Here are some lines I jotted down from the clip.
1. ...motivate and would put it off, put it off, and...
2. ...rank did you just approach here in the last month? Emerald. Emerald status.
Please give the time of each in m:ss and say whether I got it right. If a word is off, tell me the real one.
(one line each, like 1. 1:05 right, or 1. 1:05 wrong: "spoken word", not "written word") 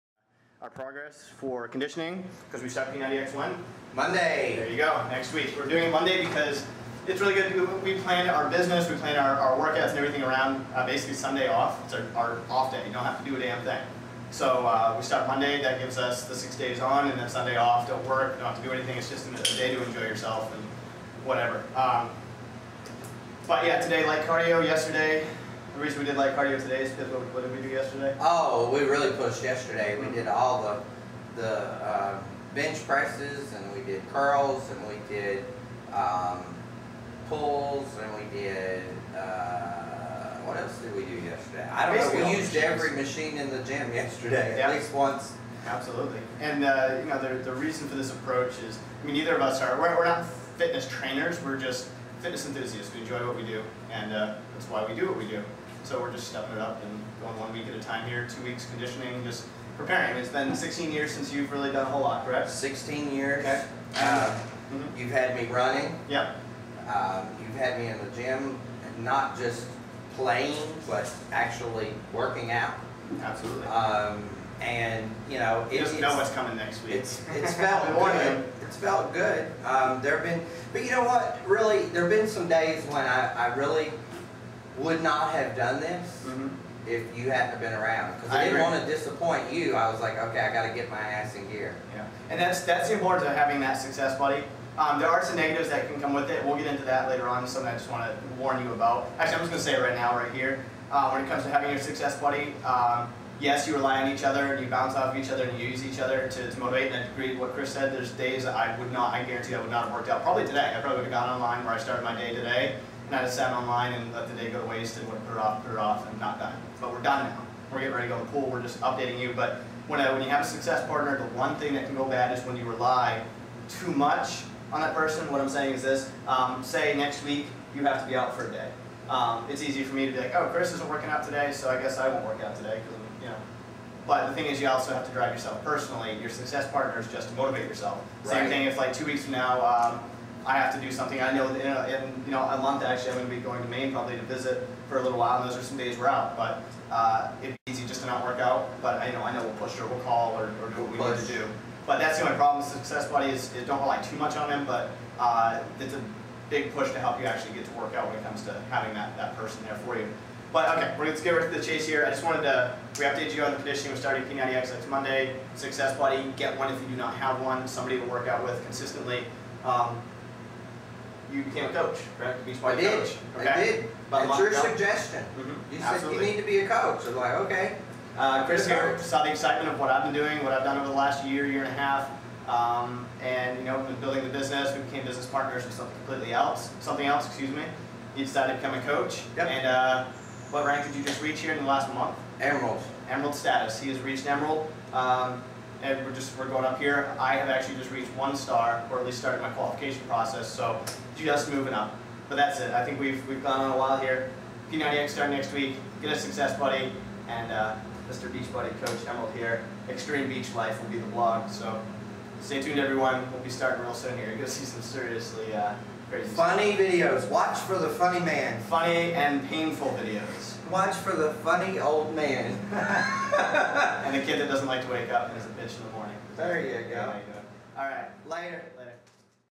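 1. 1:54 wrong: "waste", not "motivate"
2. 3:10 wrong: "reach", not "approach".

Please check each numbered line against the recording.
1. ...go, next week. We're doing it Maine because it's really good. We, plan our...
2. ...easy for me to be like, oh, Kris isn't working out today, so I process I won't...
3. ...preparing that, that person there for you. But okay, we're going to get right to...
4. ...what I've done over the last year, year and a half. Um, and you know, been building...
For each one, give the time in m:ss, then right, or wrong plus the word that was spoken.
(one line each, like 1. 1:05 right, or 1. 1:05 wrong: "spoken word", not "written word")
1. 0:04 wrong: "Monday", not "Maine"
2. 2:09 wrong: "guess", not "process"
3. 2:38 wrong: "having", not "preparing"
4. 3:00 right.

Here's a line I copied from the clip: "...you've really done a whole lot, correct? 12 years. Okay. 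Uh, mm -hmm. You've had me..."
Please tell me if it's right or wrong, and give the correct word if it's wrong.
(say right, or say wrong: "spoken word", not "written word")
wrong: "16", not "12".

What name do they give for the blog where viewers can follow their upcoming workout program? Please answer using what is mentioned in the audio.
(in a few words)
Extreme Beach Life.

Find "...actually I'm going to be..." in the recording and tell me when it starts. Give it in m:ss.
2:22.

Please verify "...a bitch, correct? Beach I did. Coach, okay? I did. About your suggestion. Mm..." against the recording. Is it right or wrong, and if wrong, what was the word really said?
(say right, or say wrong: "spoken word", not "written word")
wrong: "coach", not "bitch".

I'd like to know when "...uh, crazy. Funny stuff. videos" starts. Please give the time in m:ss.
3:35.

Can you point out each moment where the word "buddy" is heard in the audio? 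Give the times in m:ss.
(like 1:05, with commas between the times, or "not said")
1:34, 1:42, 2:33, 2:45, 3:26.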